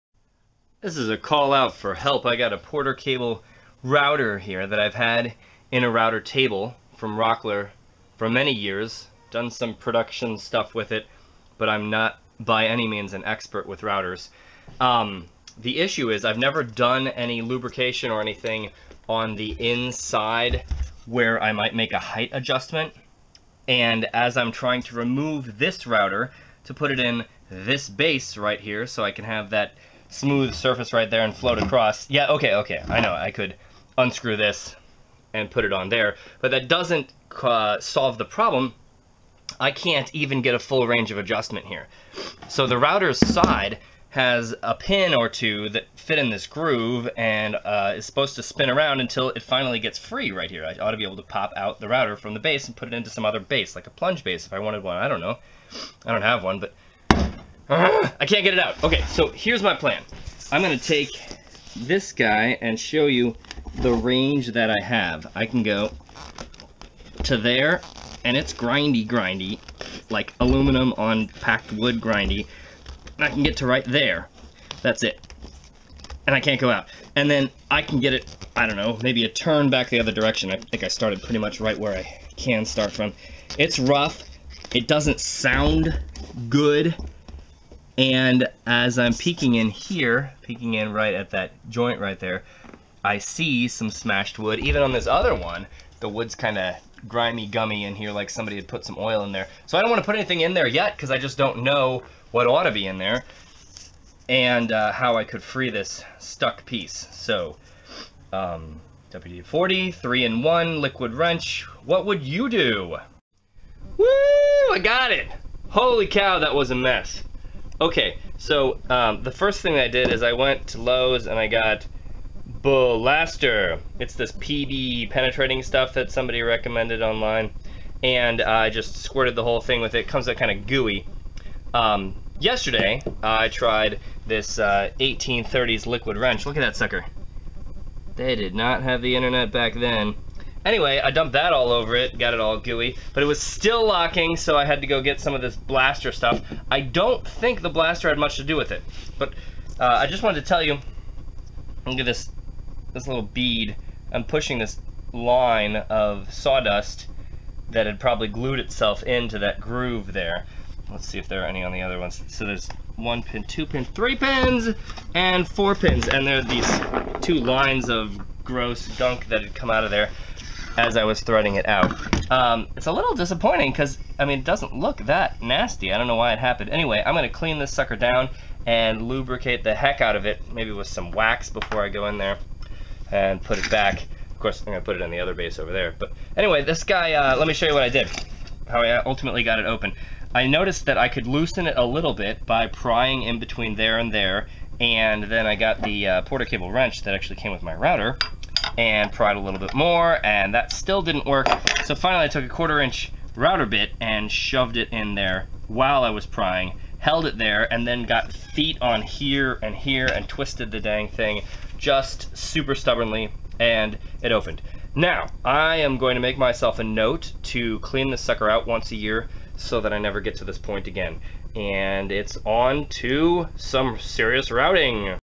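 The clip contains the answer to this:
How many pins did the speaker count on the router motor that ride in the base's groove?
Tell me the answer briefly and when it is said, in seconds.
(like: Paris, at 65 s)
4, at 165 s.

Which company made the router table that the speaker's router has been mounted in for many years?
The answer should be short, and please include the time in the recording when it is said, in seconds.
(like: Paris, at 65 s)
Rockler, at 7 s.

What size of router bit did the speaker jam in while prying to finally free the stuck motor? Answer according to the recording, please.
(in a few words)
1/4 inch.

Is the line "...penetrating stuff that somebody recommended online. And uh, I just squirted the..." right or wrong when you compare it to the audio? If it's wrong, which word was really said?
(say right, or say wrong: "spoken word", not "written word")
right.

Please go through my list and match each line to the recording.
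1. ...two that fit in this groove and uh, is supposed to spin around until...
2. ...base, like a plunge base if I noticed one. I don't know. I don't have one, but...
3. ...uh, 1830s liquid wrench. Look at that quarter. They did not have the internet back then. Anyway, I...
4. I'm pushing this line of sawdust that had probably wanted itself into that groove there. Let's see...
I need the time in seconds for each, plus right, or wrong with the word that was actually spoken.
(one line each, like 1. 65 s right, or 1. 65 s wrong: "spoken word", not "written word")
1. 45 s right
2. 53 s wrong: "wanted", not "noticed"
3. 134 s wrong: "sucker", not "quarter"
4. 154 s wrong: "glued", not "wanted".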